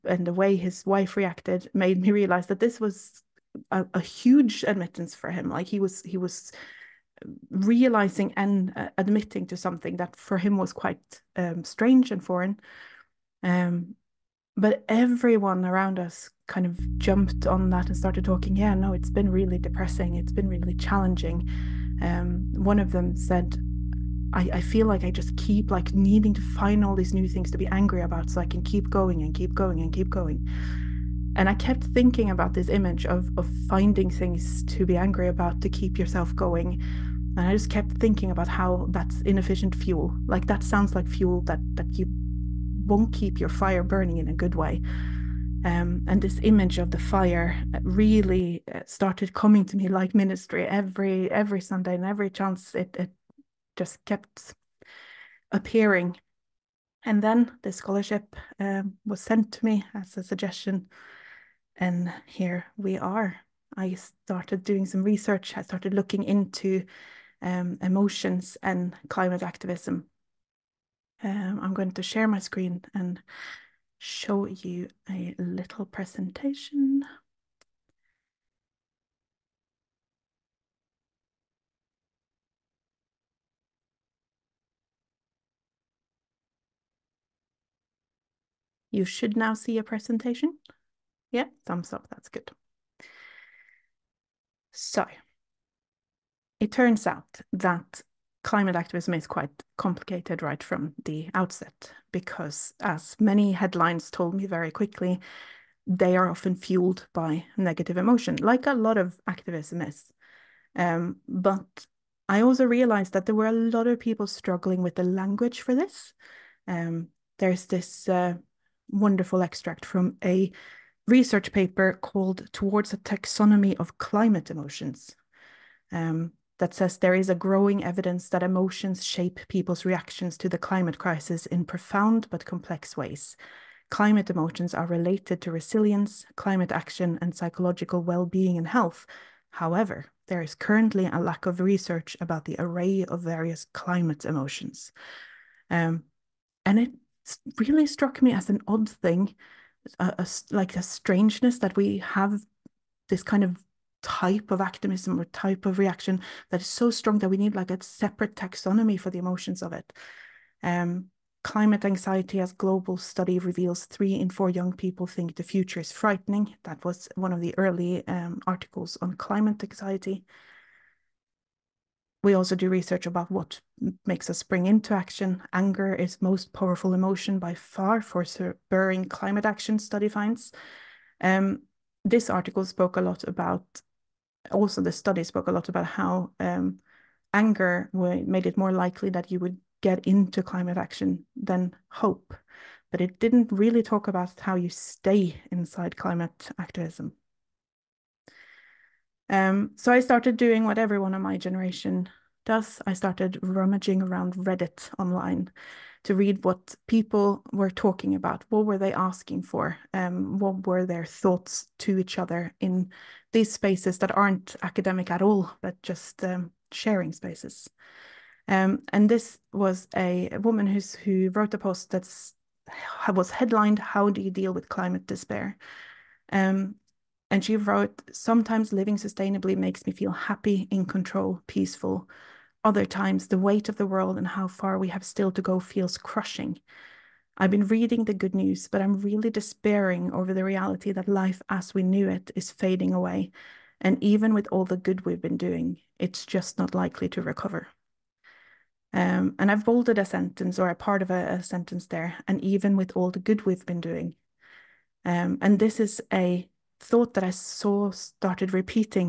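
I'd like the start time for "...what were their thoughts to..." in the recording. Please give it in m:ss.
3:30.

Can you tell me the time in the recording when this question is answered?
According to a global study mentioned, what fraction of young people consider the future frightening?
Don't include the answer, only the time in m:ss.
2:43.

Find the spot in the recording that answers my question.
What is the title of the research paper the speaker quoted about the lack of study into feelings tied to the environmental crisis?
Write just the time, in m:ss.
2:02.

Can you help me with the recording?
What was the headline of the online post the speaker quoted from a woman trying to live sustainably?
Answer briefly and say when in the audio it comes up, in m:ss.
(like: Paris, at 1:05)
How Do You Deal with Climate Despair?, at 3:43.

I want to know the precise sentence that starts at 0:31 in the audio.
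And I kept thinking about this image of of finding things to be angry about to keep yourself going.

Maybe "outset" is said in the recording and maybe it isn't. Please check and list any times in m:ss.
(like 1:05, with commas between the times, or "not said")
1:41.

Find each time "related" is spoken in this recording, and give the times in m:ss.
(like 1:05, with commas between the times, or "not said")
2:14.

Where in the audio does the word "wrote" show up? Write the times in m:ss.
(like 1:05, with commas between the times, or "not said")
3:41, 3:47.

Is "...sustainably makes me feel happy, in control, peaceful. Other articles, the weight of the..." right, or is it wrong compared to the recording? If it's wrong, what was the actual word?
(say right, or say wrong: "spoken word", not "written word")
wrong: "times", not "articles".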